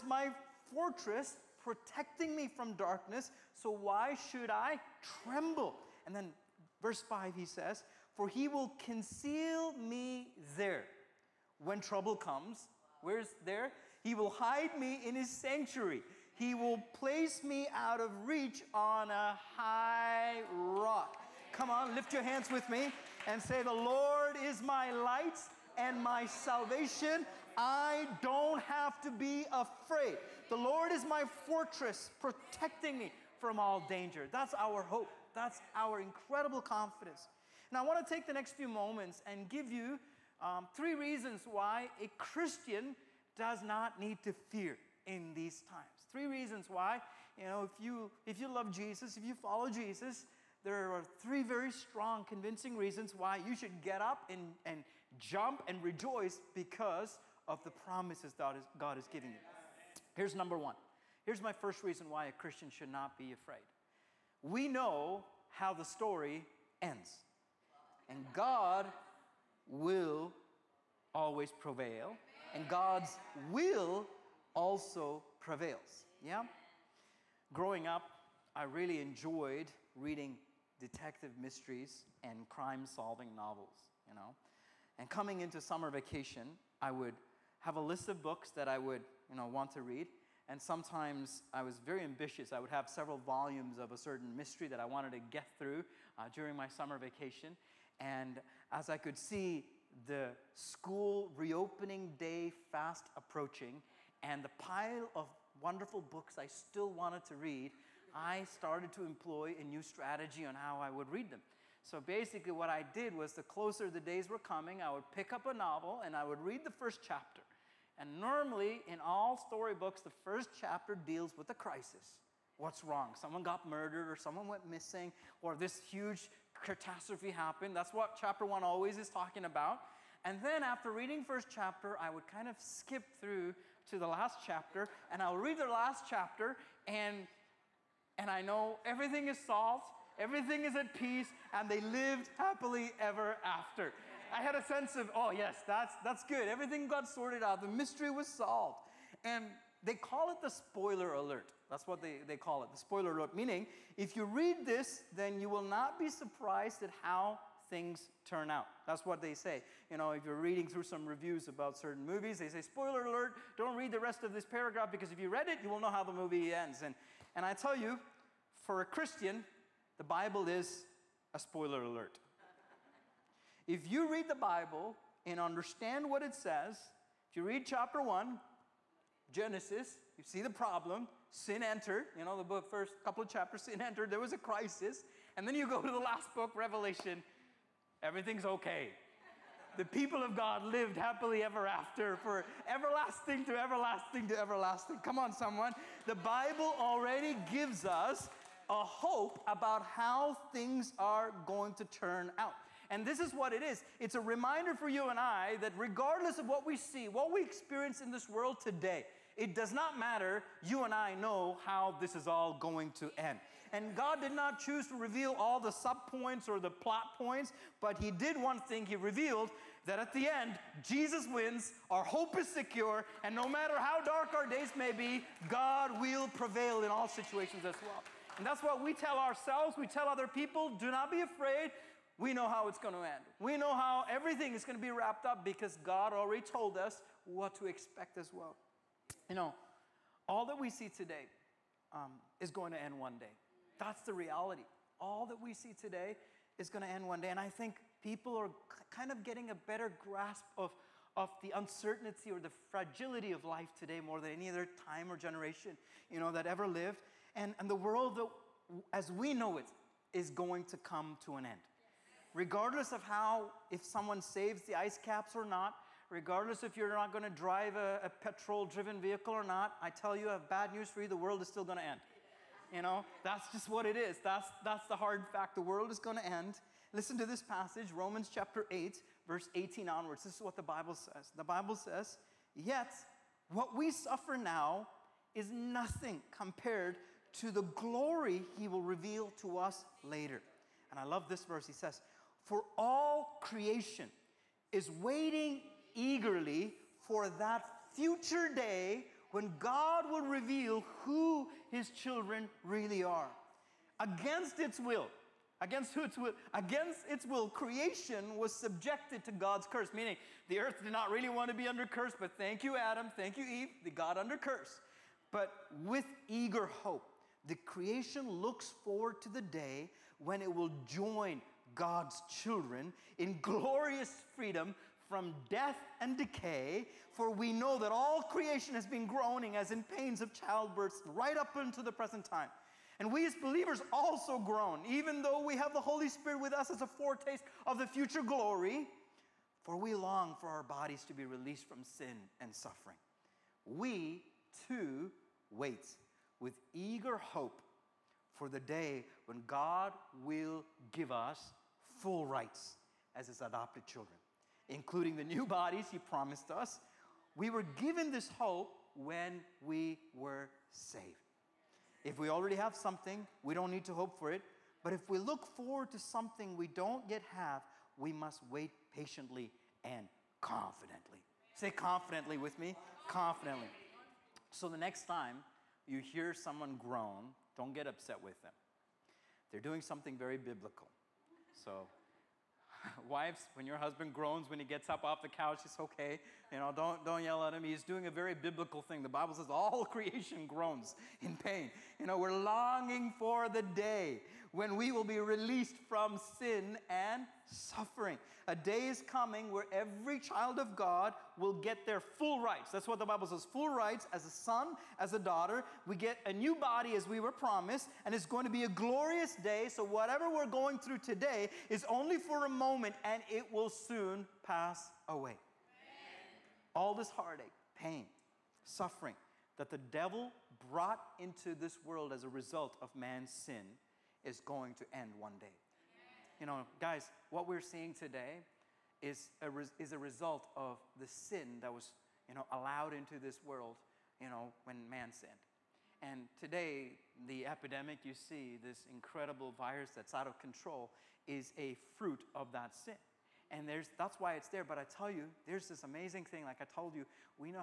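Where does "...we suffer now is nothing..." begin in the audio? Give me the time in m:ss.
4:43.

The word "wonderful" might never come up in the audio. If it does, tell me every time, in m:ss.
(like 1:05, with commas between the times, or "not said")
1:45.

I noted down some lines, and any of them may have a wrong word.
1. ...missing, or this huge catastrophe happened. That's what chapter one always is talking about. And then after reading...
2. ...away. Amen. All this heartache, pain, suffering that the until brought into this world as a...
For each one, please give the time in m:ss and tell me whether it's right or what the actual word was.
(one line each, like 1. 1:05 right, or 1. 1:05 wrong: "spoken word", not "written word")
1. 2:04 right
2. 6:55 wrong: "devil", not "until".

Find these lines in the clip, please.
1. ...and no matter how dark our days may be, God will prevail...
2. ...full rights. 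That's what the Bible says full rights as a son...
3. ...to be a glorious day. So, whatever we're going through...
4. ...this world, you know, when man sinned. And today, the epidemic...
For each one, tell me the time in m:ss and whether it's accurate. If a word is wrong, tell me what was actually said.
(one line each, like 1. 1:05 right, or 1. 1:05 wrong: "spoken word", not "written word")
1. 3:43 right
2. 6:41 right
3. 6:48 right
4. 7:13 right.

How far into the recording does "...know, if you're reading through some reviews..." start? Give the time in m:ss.
2:39.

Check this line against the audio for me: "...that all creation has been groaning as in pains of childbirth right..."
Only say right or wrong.
right.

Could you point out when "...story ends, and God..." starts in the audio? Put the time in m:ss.
1:05.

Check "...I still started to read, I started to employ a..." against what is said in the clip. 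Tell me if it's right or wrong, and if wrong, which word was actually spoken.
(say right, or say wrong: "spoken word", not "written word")
wrong: "wanted", not "started".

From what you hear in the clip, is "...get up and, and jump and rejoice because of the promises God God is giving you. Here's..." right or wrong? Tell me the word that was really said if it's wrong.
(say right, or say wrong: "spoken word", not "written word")
right.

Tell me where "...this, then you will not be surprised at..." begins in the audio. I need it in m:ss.
2:34.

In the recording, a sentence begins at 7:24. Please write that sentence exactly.
But I tell you, there's this amazing thing.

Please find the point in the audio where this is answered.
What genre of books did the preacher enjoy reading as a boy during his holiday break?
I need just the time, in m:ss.
1:20.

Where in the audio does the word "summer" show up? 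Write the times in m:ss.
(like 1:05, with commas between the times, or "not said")
1:25, 1:36.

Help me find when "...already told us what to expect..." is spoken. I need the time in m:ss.
3:56.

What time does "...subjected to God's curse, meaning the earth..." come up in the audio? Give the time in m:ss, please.
5:08.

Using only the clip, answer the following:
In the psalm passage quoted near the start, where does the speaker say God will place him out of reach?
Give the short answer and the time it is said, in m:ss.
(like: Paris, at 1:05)
on a high rock, at 0:18.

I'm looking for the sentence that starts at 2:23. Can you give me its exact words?
I had a sense of, oh, yes, that's, that's good.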